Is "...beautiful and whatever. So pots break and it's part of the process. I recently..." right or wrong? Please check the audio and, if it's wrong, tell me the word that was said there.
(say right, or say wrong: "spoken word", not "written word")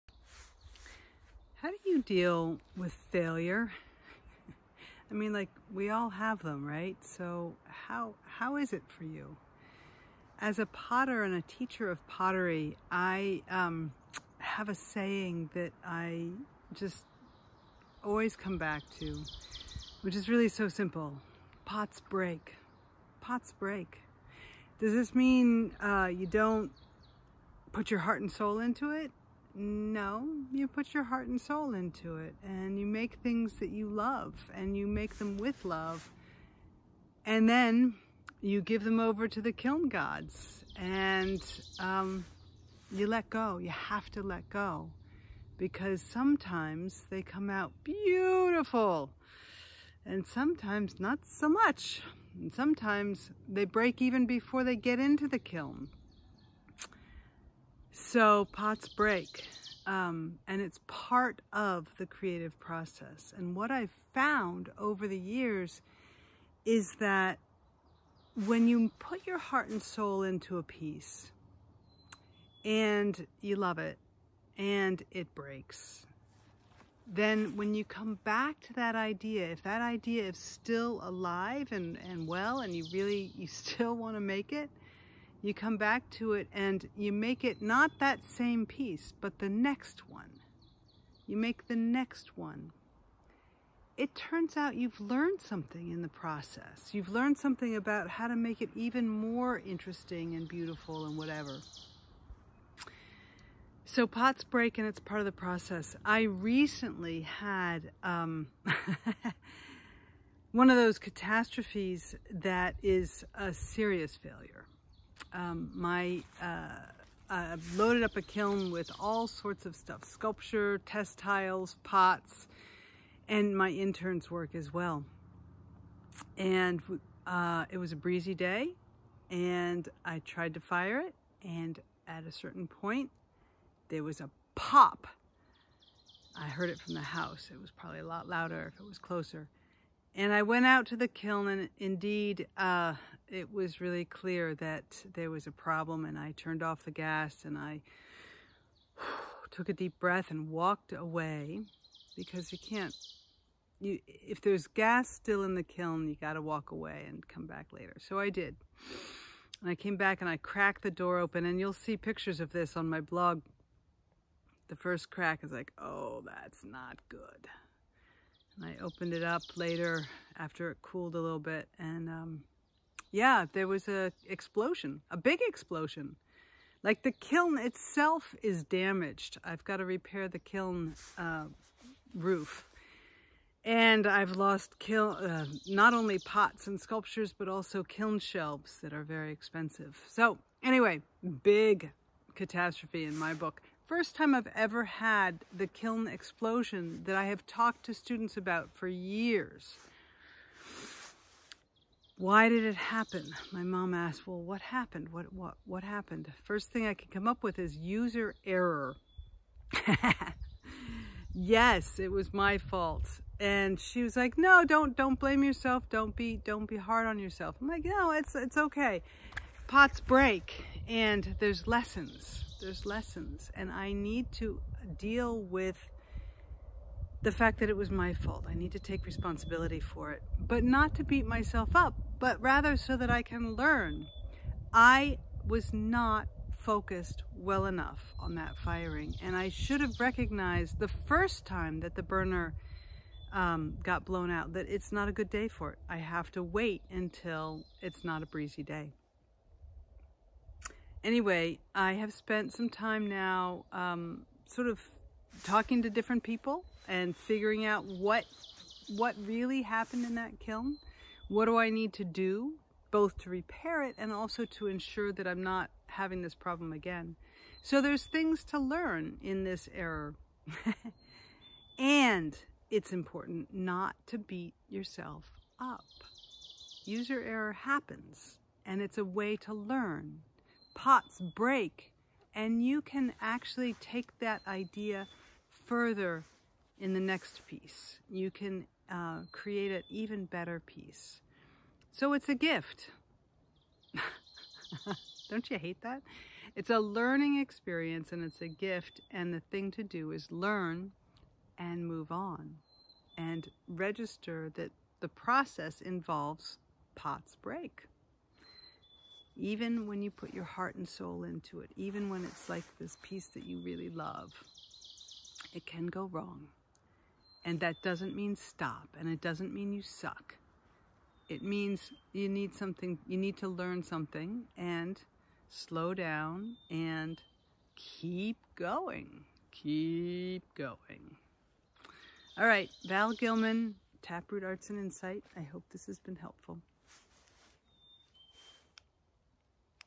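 right.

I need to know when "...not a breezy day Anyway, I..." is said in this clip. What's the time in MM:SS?
04:08.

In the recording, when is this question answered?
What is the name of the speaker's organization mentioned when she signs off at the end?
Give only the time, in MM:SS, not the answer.
05:34.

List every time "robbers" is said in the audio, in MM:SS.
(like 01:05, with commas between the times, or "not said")
not said.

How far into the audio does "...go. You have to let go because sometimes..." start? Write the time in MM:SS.
00:43.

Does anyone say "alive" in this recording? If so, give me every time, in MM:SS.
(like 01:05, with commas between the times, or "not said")
01:21.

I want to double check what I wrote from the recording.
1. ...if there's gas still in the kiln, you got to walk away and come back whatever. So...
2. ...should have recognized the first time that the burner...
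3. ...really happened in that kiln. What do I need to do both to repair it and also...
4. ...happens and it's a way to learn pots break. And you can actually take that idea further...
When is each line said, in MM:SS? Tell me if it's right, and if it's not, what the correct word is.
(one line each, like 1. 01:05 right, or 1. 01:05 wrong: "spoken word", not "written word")
1. 02:34 wrong: "later", not "whatever"
2. 03:59 right
3. 04:19 right
4. 04:37 right.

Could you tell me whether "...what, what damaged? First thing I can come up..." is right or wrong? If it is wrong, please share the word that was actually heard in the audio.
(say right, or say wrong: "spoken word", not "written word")
wrong: "happened", not "damaged".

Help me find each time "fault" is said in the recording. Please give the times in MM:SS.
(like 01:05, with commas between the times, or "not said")
03:32, 03:48.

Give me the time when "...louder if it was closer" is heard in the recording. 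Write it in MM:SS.
02:18.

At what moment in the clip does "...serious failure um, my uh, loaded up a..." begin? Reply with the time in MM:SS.
01:53.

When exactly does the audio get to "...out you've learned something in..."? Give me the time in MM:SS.
01:34.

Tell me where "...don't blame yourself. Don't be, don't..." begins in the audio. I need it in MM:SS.
03:34.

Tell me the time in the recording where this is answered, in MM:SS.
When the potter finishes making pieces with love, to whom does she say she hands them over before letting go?
00:39.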